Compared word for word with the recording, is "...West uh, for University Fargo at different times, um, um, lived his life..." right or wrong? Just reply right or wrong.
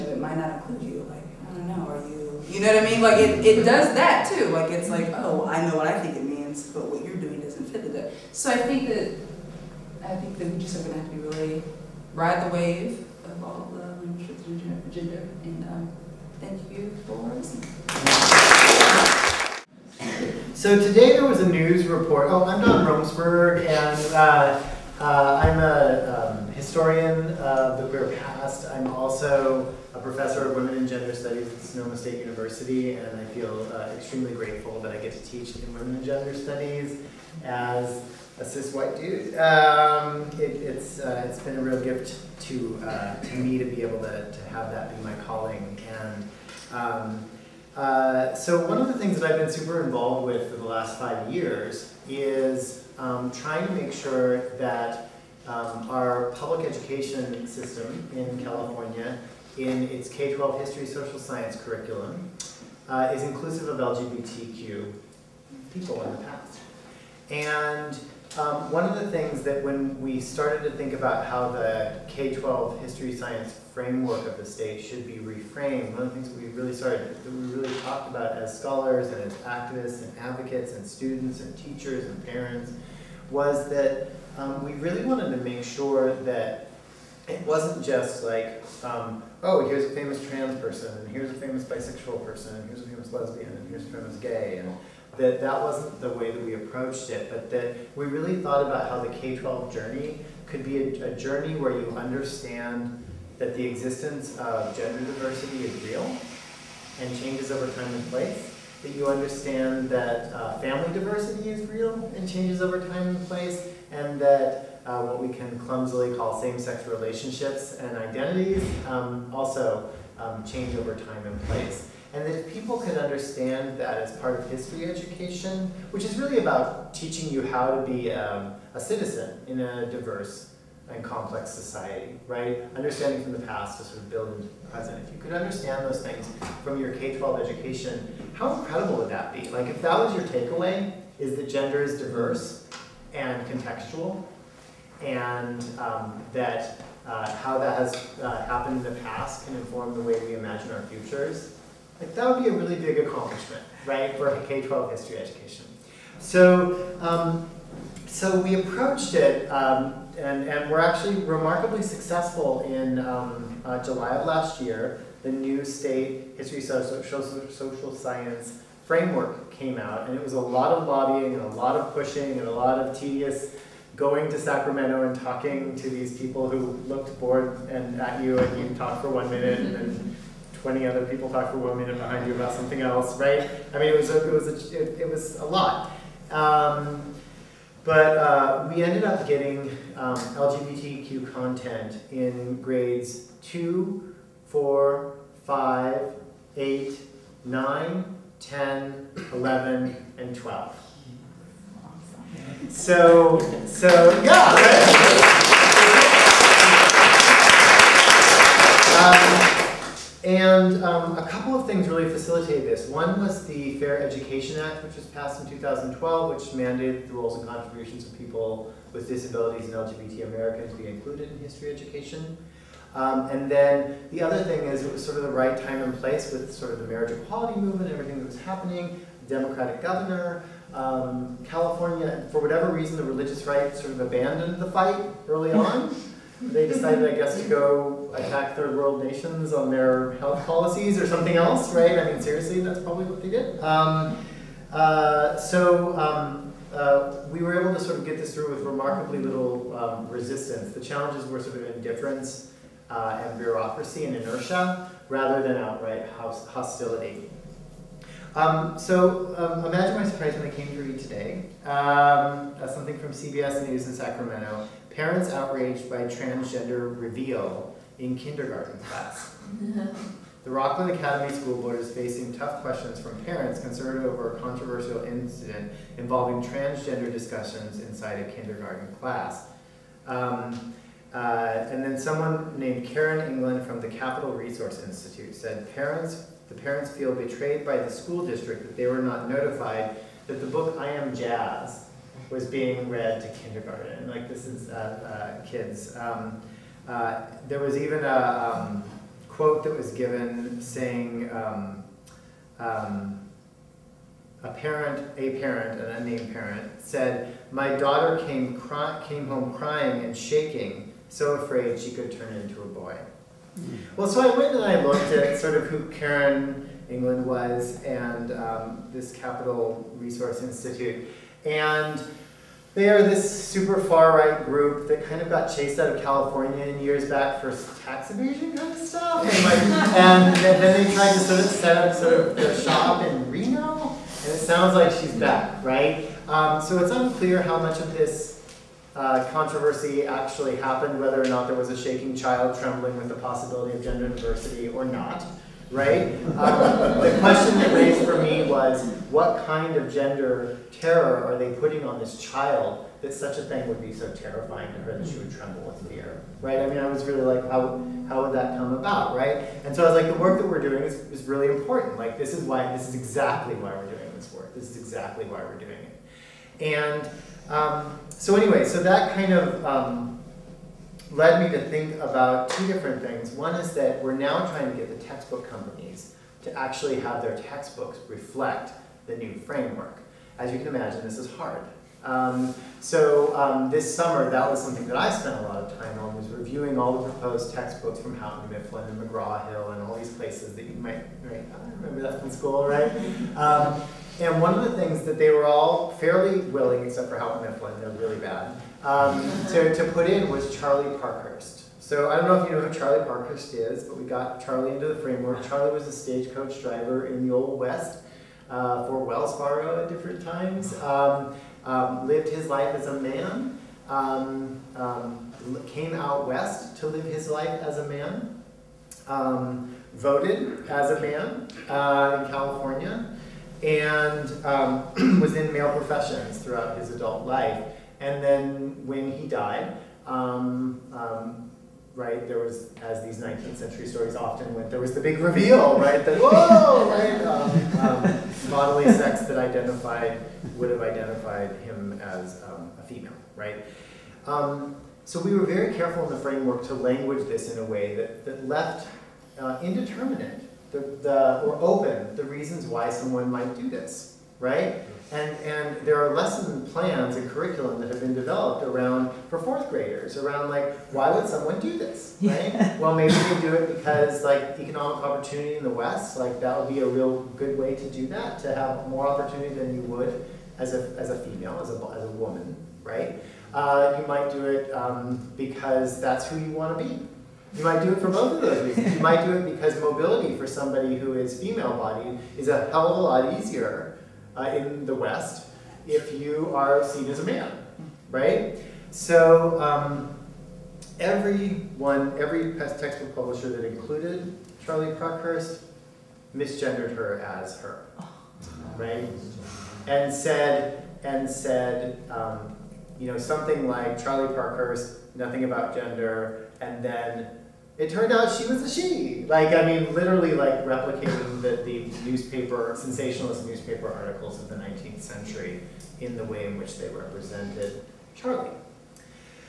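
wrong.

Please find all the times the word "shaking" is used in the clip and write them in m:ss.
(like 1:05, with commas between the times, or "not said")
5:10, 5:41.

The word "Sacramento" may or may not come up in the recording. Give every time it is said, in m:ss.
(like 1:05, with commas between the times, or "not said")
2:54, 4:23.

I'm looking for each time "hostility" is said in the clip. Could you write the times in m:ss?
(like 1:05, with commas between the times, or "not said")
4:16.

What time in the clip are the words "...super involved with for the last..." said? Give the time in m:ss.
0:49.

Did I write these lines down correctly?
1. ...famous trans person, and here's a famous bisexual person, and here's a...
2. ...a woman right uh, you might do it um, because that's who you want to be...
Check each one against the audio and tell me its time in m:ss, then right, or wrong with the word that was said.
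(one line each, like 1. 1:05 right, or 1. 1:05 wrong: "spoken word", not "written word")
1. 1:29 right
2. 7:52 right.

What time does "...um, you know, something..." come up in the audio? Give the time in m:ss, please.
8:22.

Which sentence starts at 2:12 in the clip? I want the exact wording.
Understanding from the past to sort of build into the present.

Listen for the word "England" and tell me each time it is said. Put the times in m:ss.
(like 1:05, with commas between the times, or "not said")
4:43, 5:16.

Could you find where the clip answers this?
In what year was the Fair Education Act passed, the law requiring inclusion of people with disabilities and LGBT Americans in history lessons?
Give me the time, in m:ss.
3:35.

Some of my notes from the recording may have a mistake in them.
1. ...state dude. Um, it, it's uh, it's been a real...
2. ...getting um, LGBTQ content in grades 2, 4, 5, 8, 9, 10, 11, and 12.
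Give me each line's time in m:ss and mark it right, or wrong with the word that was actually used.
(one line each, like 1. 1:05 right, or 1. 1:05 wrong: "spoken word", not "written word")
1. 0:38 wrong: "white", not "state"
2. 3:09 right.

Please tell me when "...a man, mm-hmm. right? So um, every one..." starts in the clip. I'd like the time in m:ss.
8:07.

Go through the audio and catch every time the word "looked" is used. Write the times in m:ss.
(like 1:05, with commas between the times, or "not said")
2:56, 5:14.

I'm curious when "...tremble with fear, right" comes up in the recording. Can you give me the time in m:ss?
5:55.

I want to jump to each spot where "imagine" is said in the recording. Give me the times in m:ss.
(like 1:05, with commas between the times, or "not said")
2:30, 4:19, 6:20.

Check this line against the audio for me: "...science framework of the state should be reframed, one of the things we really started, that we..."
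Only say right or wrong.
right.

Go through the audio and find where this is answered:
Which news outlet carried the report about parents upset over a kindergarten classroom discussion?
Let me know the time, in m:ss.
4:23.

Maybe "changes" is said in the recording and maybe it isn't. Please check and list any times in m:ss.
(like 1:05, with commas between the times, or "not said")
1:47, 1:52, 2:00.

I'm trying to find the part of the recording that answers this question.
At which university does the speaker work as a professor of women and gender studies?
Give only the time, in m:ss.
0:31.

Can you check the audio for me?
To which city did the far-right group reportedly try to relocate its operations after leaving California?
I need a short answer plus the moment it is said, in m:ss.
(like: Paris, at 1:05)
Reno, at 5:33.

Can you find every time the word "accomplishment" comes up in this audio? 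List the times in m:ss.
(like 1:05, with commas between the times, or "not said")
2:32.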